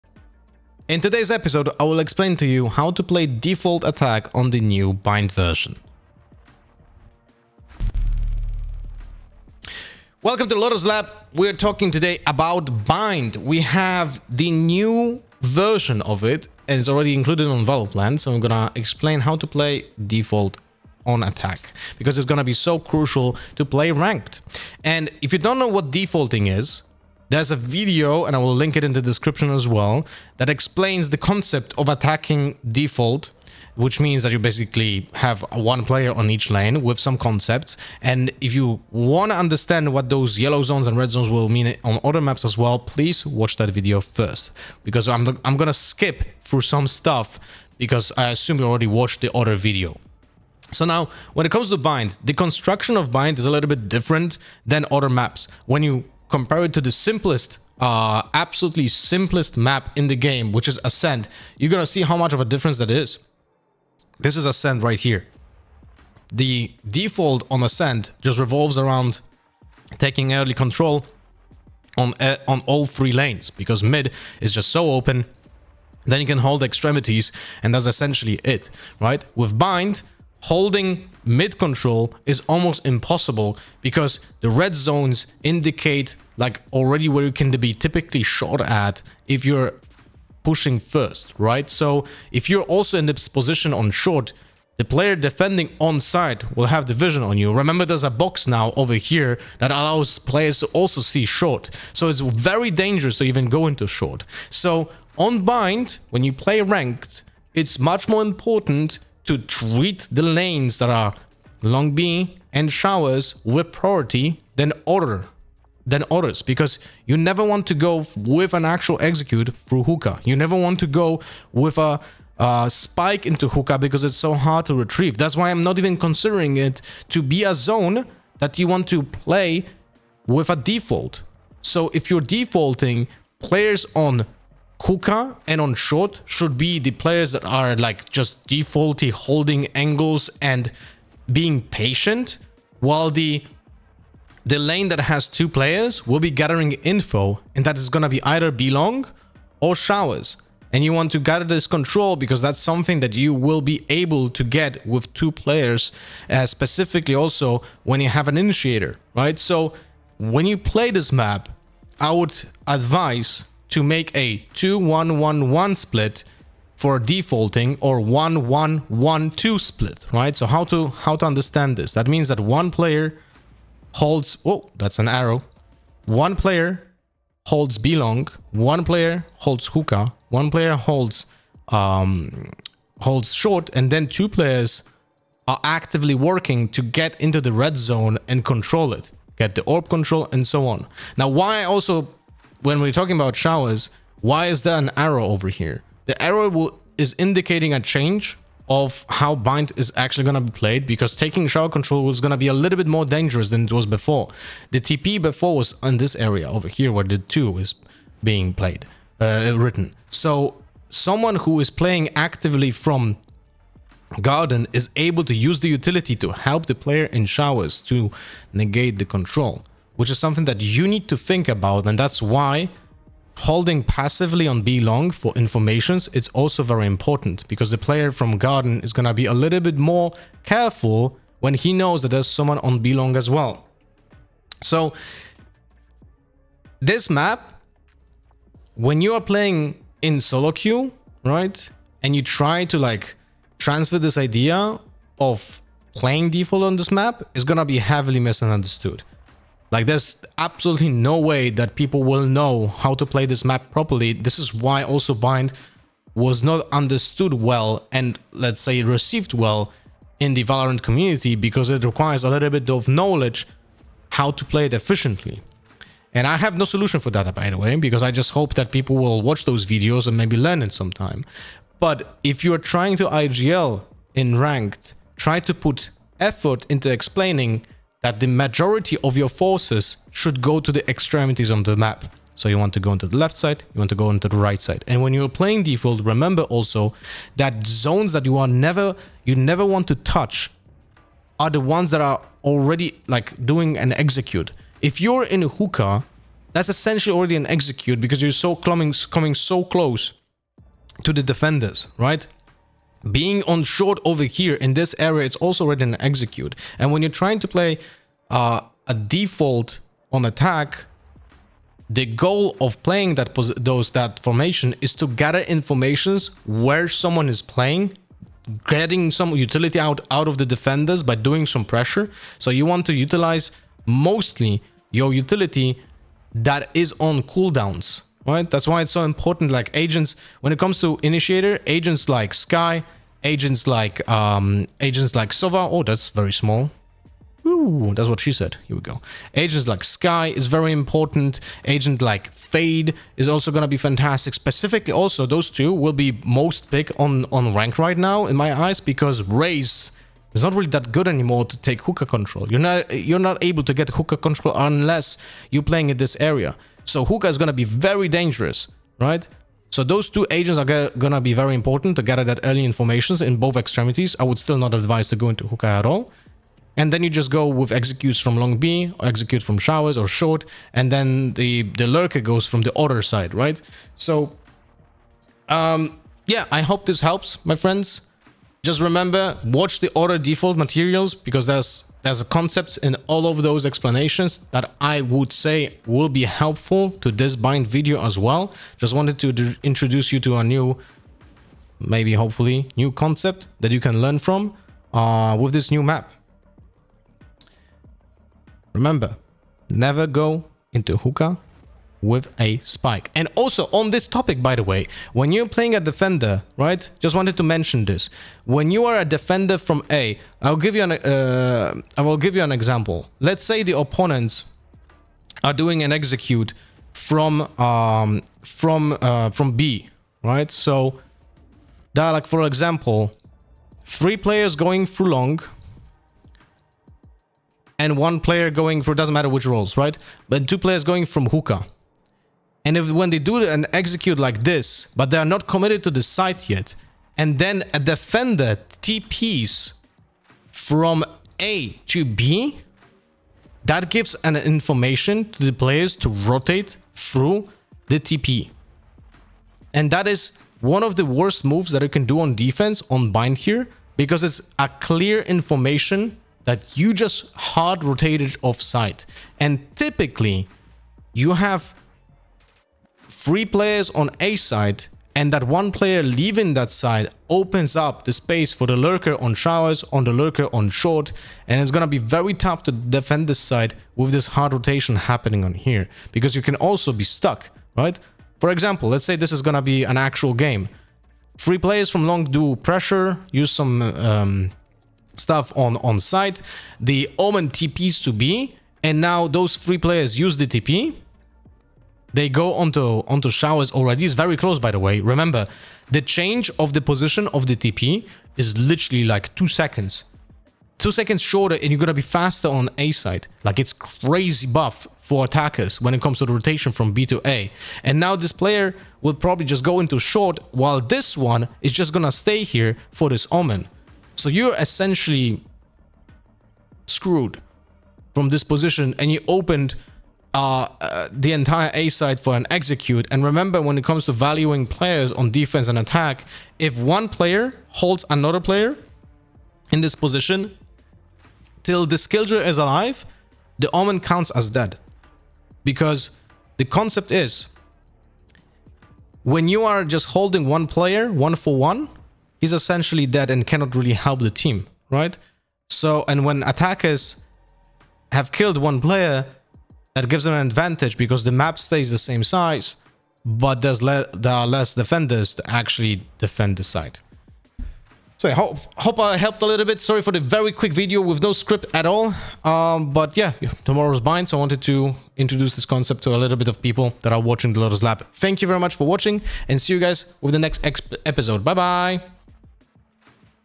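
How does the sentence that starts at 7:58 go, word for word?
For example, let's say this is going to be an actual game.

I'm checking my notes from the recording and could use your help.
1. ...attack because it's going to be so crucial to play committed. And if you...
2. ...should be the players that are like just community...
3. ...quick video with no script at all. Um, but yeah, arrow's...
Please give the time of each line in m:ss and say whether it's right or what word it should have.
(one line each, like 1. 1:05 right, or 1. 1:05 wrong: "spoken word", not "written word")
1. 0:21 wrong: "ranked", not "committed"
2. 2:16 wrong: "defaulty", not "community"
3. 9:20 wrong: "tomorrow", not "arrow".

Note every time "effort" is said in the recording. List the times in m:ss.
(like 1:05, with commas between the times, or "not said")
4:36.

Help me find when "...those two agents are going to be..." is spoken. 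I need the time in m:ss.
5:59.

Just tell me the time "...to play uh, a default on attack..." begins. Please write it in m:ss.
5:07.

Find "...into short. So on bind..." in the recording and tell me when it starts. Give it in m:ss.
1:43.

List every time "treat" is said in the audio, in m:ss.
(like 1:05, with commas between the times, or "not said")
1:49.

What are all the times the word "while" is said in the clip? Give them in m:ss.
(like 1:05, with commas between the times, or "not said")
2:22, 8:30.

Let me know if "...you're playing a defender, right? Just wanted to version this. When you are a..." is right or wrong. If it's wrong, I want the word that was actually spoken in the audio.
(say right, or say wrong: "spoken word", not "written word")
wrong: "mention", not "version".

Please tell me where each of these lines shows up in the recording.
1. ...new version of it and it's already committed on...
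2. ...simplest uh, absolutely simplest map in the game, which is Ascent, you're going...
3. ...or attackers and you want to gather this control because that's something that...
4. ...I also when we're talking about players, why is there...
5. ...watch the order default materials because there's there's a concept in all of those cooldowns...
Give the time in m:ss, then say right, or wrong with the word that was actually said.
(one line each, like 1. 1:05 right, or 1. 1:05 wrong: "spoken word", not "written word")
1. 0:14 wrong: "included", not "committed"
2. 0:56 right
3. 2:29 wrong: "showers", not "attackers"
4. 3:11 wrong: "showers", not "players"
5. 6:19 wrong: "explanations", not "cooldowns".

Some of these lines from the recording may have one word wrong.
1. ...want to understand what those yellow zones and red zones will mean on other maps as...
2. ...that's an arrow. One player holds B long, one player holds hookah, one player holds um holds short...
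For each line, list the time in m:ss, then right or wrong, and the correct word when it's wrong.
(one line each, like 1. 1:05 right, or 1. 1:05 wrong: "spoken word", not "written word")
1. 0:38 right
2. 2:54 right.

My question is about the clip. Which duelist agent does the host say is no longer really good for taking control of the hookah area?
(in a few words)
Raze.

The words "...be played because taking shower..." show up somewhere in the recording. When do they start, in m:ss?
3:20.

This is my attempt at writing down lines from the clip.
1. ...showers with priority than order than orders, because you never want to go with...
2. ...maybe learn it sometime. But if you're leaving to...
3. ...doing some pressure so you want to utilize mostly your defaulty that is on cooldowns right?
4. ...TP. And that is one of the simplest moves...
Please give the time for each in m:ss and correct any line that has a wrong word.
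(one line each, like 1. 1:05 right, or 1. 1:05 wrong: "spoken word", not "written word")
1. 1:52 right
2. 4:30 wrong: "trying", not "leaving"
3. 5:21 wrong: "utility", not "defaulty"
4. 7:27 wrong: "worst", not "simplest".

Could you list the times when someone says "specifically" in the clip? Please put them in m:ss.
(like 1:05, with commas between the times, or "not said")
2:36, 5:44.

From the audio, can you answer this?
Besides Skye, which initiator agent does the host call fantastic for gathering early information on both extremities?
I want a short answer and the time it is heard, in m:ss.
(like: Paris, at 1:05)
Fade, at 5:42.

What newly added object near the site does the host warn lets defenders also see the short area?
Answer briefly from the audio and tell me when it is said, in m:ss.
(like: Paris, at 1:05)
a box, at 1:38.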